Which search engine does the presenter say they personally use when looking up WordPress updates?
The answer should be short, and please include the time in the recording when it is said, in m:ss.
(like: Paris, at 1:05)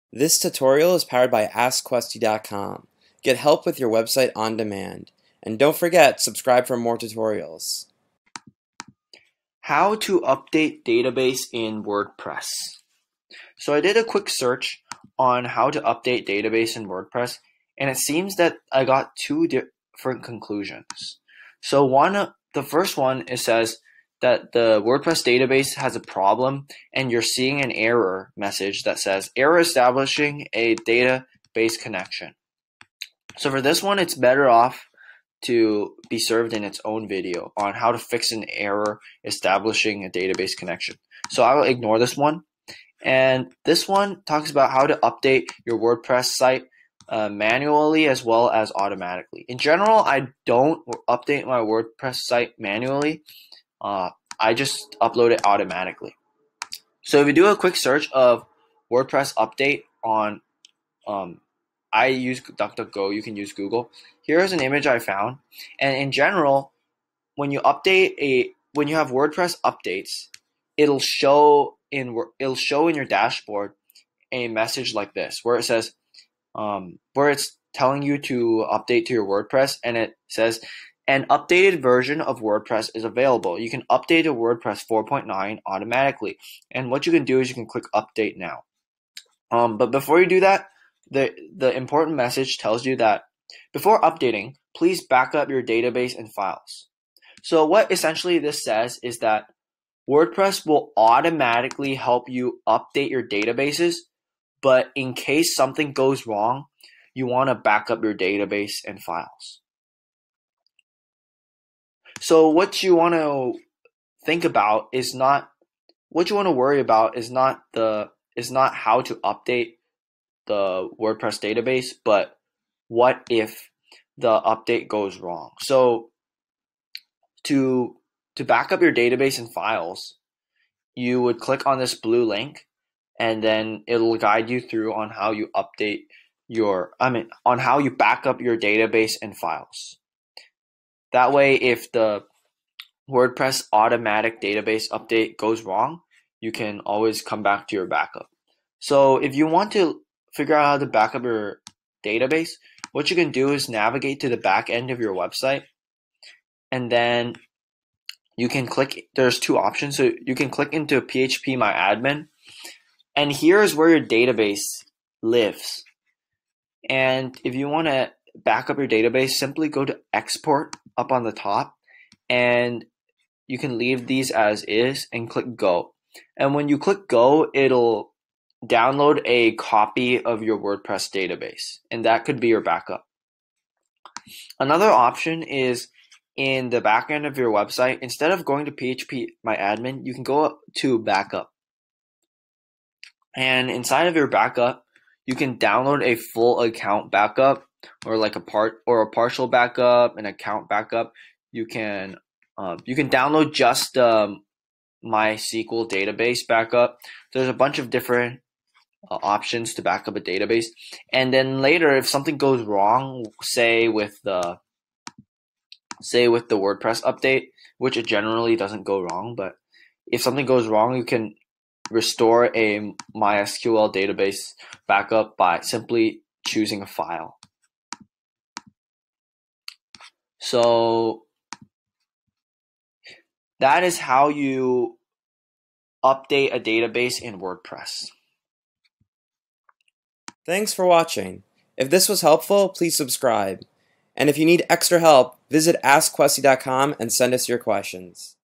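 DuckDuckGo, at 1:02.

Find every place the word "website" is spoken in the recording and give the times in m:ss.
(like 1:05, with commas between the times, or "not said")
0:03, 2:35, 3:07.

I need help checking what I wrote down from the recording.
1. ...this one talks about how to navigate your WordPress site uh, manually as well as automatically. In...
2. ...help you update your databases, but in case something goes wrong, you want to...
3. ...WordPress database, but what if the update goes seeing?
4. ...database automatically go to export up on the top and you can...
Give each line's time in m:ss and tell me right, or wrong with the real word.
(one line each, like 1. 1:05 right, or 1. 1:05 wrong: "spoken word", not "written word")
1. 0:43 wrong: "update", not "navigate"
2. 1:41 right
3. 2:01 wrong: "wrong", not "seeing"
4. 2:48 wrong: "simply", not "automatically".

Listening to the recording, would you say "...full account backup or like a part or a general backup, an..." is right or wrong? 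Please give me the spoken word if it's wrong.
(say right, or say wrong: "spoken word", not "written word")
wrong: "partial", not "general".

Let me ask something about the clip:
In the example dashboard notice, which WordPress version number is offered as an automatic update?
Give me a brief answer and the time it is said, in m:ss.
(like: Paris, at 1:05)
4.9, at 1:24.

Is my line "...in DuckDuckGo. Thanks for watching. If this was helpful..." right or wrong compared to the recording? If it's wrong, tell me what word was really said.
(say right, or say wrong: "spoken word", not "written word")
wrong: "WordPress", not "DuckDuckGo".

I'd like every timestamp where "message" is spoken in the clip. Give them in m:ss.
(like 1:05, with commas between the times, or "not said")
0:28, 1:14, 1:32.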